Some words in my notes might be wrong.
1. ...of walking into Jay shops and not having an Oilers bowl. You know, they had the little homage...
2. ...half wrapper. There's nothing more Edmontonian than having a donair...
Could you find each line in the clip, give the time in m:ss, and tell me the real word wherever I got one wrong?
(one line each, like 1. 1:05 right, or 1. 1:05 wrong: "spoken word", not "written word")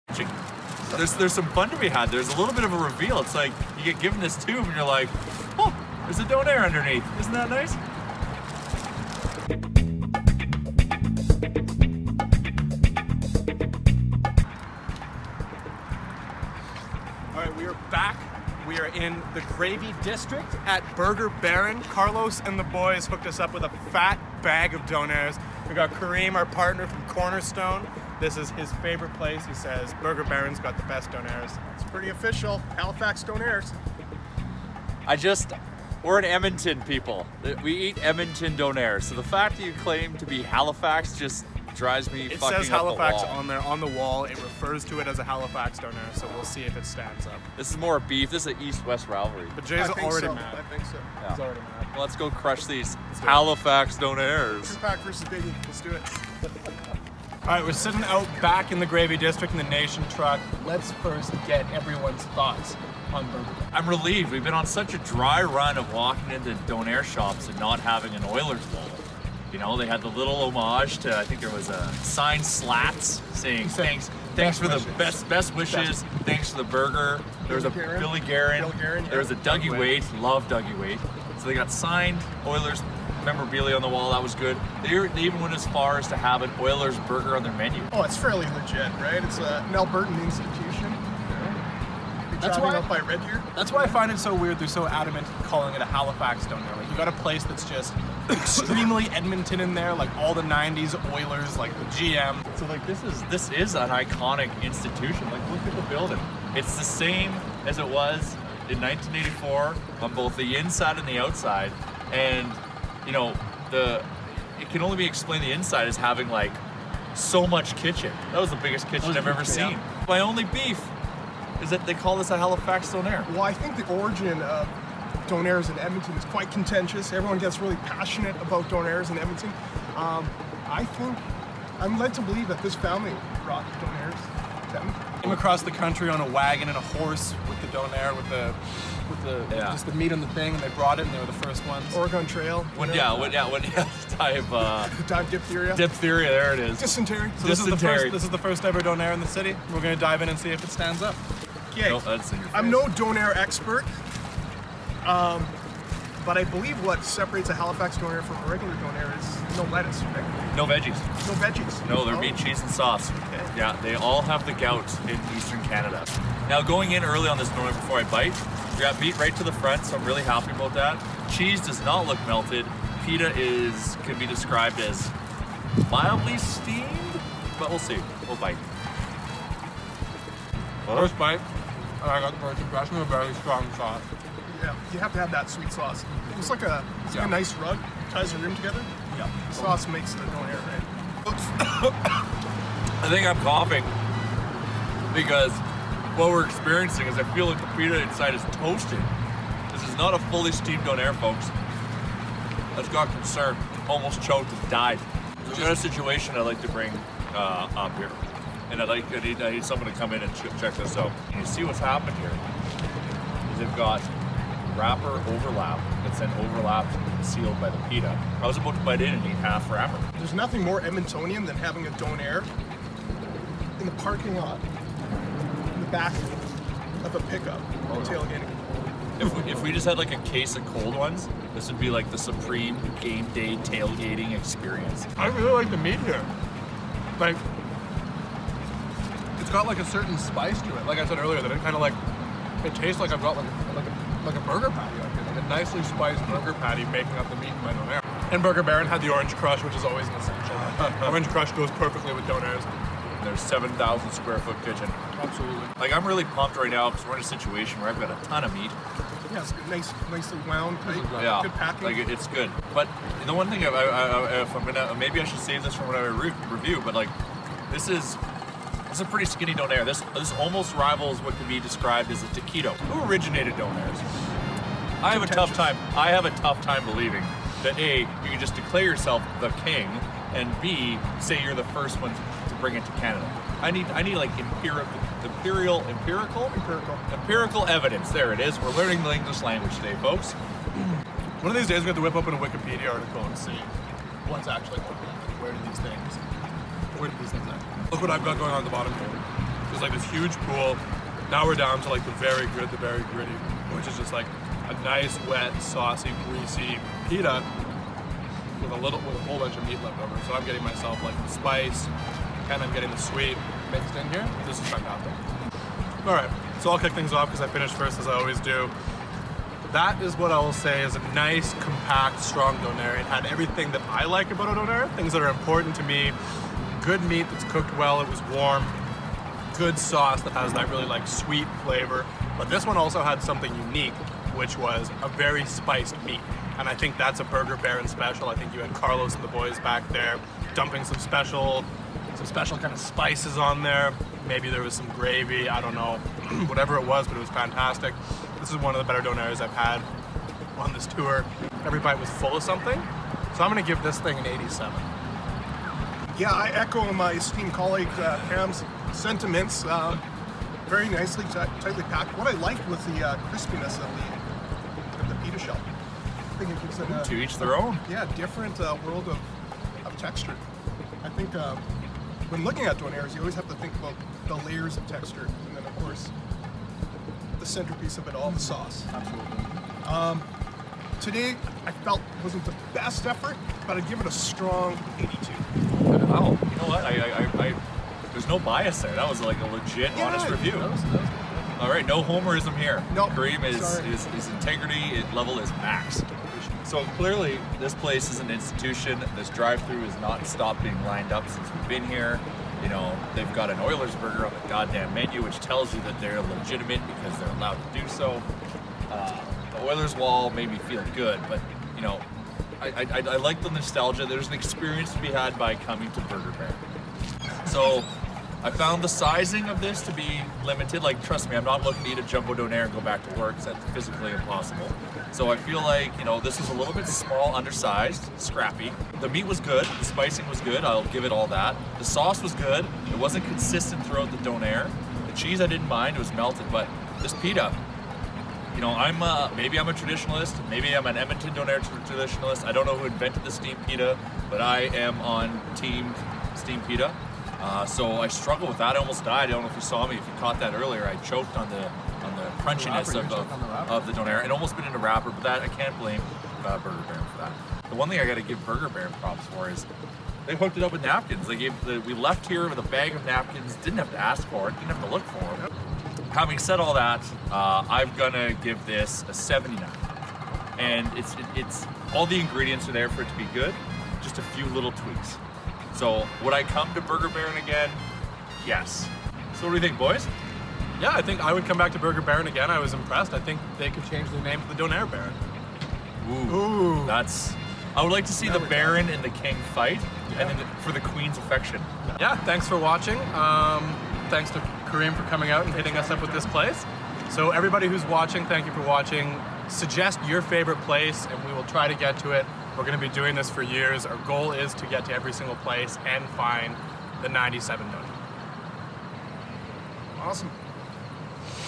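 1. 1:05 wrong: "Donair", not "Jay"
2. 3:39 right.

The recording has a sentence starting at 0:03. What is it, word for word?
It's like you get given this tomb and you're like, oh, there's a donair underneath.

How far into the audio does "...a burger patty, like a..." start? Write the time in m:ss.
4:04.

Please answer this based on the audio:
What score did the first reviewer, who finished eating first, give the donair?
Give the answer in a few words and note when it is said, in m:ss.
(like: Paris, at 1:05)
87, at 5:54.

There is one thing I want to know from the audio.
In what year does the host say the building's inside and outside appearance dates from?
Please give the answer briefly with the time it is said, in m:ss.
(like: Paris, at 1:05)
1984, at 1:48.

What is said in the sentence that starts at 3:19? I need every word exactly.
This is not a fully steamed donair, folks.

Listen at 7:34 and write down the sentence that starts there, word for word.
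It almost been in a wrapper, but that I can't blame uh, Burger Baron for that.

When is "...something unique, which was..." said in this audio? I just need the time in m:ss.
5:33.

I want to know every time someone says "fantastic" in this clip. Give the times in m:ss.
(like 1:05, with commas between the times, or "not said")
5:14, 5:47.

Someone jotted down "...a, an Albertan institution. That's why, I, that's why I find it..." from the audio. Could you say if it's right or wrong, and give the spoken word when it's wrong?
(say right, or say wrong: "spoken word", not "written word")
right.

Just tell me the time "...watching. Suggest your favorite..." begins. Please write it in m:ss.
8:18.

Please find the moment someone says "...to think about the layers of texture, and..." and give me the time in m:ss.
6:13.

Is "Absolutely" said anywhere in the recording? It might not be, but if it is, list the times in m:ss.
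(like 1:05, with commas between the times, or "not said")
4:15, 6:18.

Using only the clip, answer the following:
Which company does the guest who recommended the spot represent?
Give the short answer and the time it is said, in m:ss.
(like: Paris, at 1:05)
Cornerstone, at 0:27.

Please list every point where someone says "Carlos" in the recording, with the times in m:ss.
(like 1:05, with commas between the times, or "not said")
0:21, 5:38.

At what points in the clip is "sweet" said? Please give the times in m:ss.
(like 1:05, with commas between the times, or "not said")
3:05, 5:12, 5:31.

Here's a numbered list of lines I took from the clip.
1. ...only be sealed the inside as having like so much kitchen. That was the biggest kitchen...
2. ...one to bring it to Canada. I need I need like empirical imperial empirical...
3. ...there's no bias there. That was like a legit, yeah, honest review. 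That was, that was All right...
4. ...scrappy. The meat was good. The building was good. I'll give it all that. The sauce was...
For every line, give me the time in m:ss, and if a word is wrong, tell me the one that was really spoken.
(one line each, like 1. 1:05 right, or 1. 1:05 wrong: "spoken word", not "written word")
1. 1:54 wrong: "explained", not "sealed"
2. 4:42 right
3. 6:28 right
4. 7:08 wrong: "spicing", not "building".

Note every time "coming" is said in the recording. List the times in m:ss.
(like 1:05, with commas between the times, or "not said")
6:55, 8:15.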